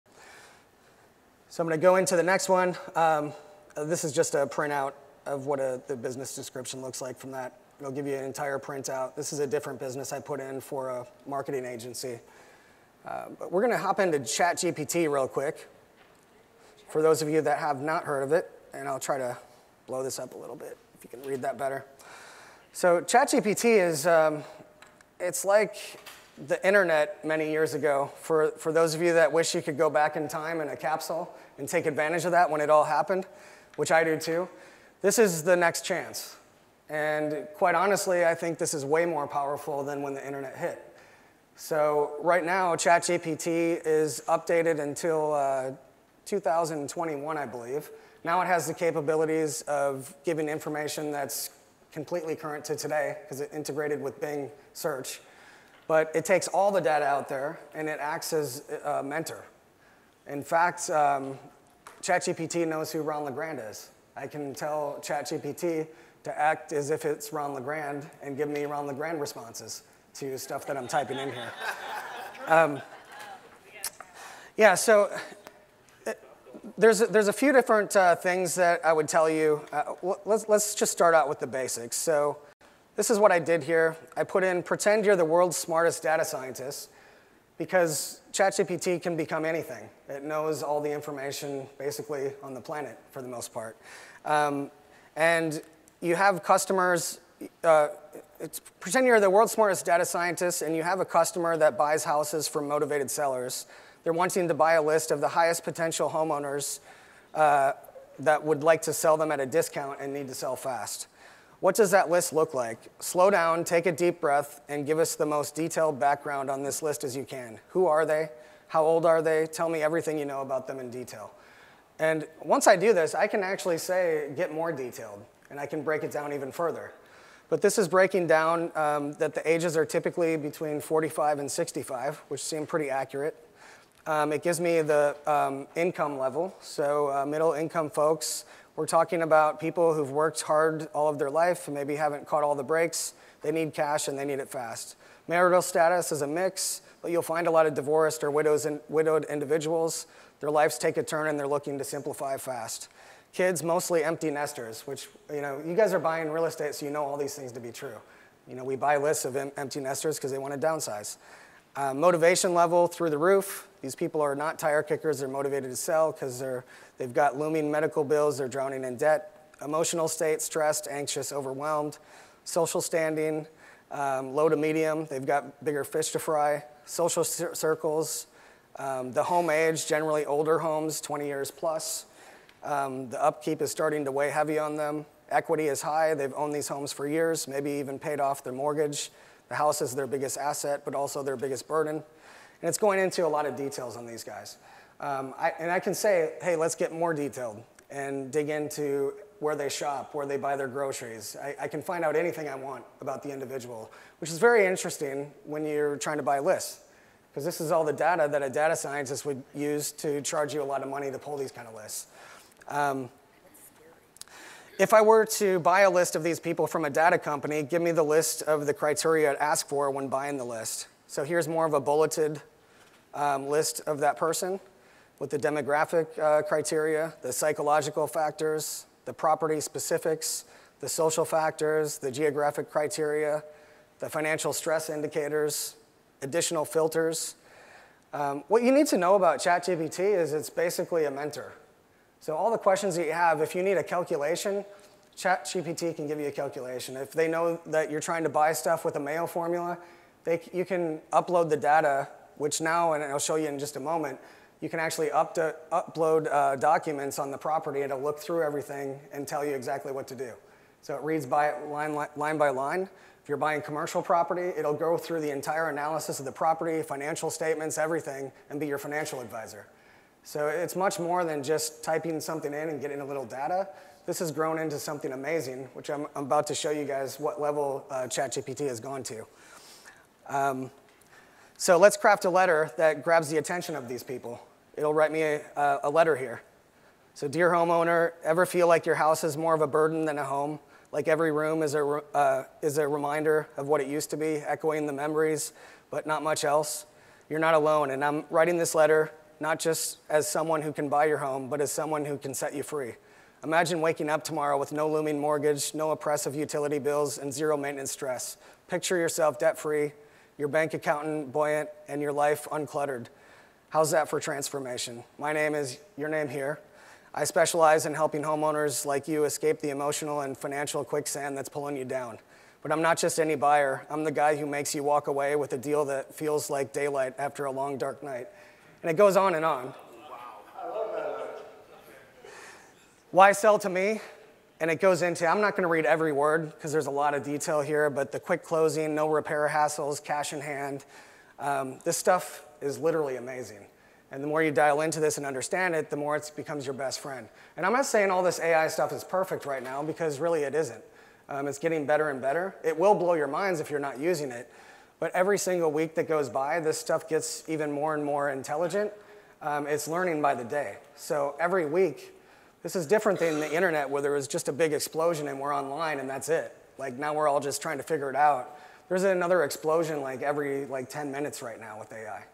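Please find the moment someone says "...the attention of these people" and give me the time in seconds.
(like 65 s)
283 s.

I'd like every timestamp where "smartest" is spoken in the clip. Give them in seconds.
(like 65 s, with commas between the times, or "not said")
85 s, 99 s.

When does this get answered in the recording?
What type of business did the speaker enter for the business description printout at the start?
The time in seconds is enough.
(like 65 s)
11 s.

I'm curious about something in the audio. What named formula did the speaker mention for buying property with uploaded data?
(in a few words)
Mayo formula.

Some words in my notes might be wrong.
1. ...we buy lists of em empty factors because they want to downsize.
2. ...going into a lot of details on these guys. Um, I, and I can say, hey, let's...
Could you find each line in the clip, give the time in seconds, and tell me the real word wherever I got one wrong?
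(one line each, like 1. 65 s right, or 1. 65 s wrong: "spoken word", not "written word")
1. 158 s wrong: "nesters", not "factors"
2. 192 s right.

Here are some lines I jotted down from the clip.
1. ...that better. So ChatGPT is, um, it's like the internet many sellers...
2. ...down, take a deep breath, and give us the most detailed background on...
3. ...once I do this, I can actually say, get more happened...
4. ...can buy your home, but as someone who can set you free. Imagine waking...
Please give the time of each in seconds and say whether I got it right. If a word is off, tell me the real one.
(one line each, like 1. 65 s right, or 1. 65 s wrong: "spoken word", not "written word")
1. 21 s wrong: "years", not "sellers"
2. 113 s right
3. 122 s wrong: "detailed", not "happened"
4. 300 s right.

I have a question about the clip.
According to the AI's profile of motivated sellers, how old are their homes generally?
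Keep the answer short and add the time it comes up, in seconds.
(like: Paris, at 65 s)
20 years plus, at 181 s.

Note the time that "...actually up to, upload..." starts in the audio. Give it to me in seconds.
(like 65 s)
254 s.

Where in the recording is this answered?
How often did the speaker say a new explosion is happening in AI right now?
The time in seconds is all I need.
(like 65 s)
370 s.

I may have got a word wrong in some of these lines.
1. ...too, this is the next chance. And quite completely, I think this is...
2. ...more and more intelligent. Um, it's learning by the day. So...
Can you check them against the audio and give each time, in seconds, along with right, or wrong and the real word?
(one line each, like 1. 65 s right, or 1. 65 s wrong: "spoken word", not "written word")
1. 34 s wrong: "honestly", not "completely"
2. 357 s right.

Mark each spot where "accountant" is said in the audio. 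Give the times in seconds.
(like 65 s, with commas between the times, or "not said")
310 s.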